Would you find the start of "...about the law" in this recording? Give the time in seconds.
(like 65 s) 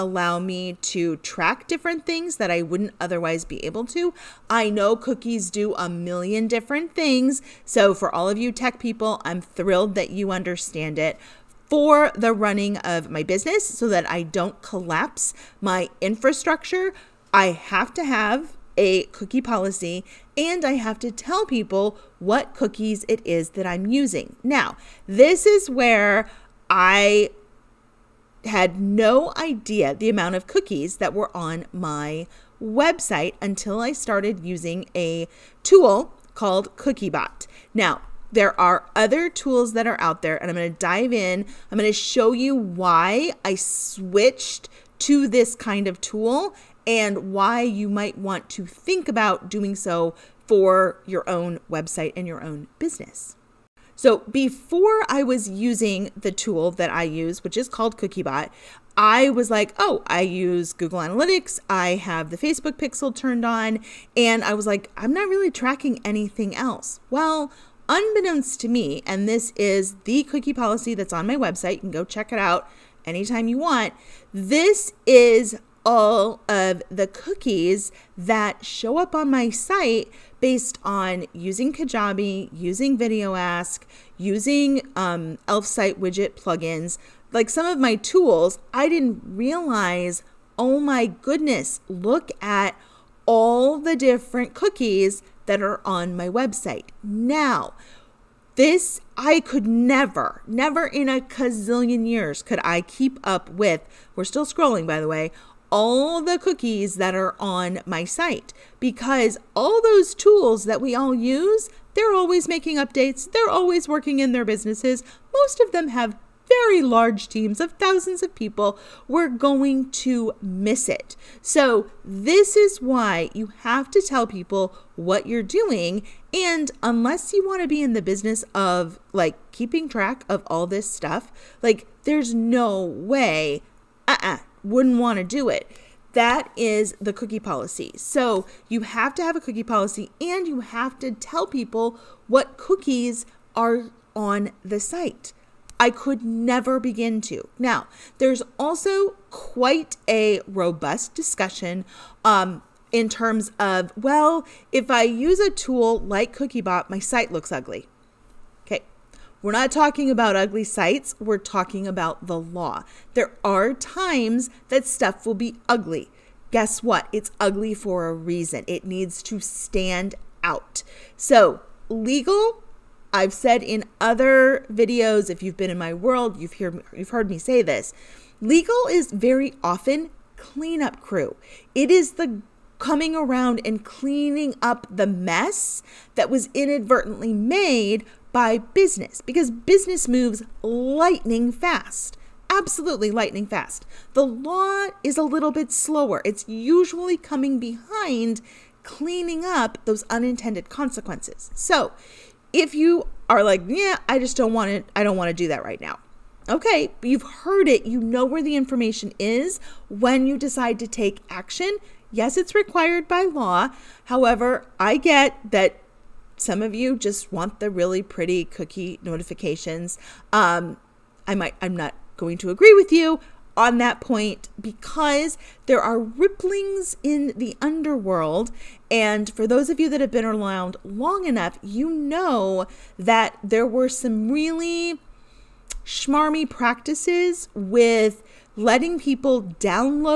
161 s.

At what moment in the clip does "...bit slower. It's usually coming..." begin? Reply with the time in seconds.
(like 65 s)
195 s.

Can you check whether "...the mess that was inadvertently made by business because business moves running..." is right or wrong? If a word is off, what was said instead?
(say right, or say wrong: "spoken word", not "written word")
wrong: "lightning", not "running".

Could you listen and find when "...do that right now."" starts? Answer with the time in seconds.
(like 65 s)
205 s.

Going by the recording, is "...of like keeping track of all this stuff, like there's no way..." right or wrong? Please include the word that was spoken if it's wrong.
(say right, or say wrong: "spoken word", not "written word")
right.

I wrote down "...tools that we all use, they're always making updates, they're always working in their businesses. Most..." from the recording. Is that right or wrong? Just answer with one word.
right.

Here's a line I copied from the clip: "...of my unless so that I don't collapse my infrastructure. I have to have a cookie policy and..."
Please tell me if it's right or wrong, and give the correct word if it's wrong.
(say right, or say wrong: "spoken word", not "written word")
wrong: "business", not "unless".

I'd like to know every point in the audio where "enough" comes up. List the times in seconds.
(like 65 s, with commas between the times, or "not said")
231 s.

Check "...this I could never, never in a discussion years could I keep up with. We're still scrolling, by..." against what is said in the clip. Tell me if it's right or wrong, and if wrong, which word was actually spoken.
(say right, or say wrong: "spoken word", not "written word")
wrong: "gazillion", not "discussion".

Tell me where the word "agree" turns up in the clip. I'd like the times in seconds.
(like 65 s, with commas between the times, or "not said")
222 s.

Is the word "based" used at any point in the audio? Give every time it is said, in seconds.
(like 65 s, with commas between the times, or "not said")
80 s.